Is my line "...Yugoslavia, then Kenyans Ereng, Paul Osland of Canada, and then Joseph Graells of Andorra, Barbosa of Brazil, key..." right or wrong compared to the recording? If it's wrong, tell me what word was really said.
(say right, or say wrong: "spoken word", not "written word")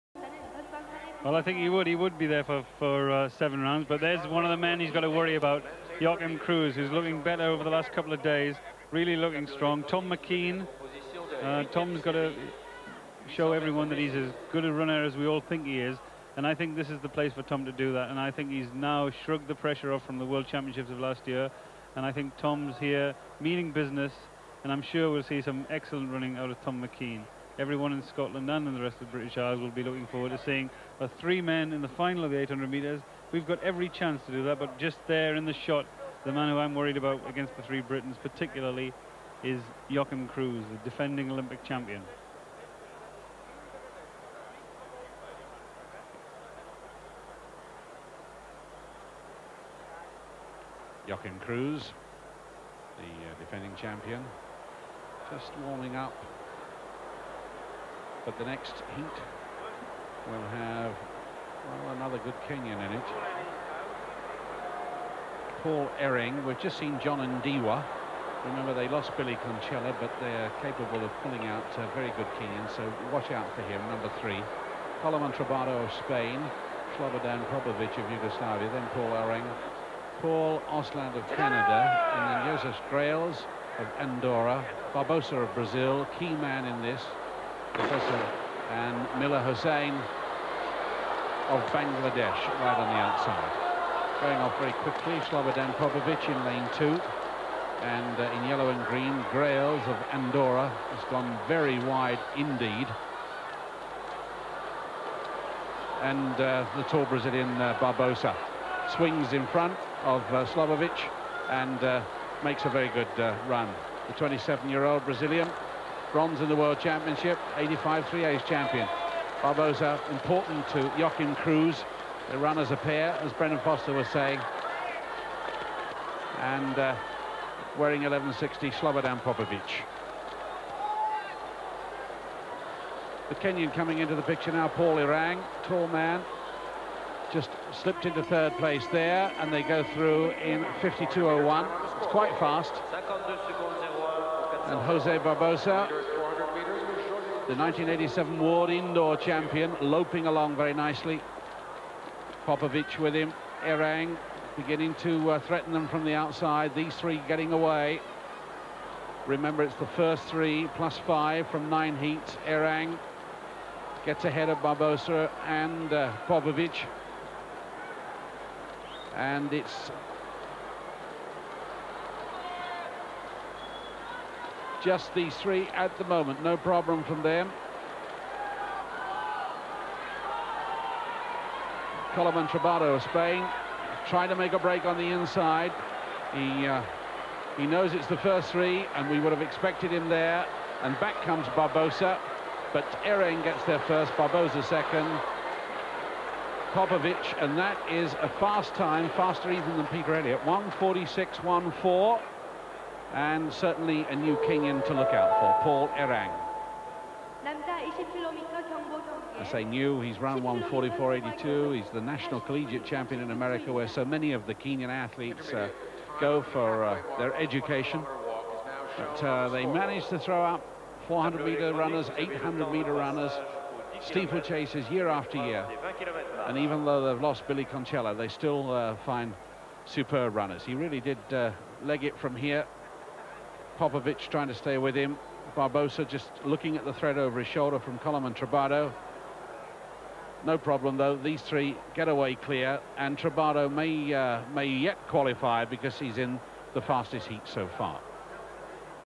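wrong: "Paul", not "Kenyans".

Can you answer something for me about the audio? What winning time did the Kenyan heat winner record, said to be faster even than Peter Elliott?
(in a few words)
1:46.14.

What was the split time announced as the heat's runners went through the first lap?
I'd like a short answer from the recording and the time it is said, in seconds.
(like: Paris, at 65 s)
52.01, at 140 s.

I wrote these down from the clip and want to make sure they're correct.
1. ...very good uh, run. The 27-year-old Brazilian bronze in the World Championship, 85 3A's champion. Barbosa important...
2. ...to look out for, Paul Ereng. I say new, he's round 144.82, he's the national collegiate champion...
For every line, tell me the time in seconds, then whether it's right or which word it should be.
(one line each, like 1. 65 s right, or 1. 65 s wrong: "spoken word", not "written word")
1. 112 s right
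2. 204 s right.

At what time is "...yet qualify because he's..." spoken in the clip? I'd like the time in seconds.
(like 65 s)
244 s.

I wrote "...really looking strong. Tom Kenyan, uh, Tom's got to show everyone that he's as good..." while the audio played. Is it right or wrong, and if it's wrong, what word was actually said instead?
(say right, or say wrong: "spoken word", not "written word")
wrong: "McKean", not "Kenyan".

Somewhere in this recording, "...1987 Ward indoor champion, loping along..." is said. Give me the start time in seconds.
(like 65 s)
147 s.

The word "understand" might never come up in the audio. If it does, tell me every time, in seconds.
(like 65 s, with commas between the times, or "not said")
not said.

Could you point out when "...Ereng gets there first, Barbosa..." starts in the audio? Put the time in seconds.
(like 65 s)
193 s.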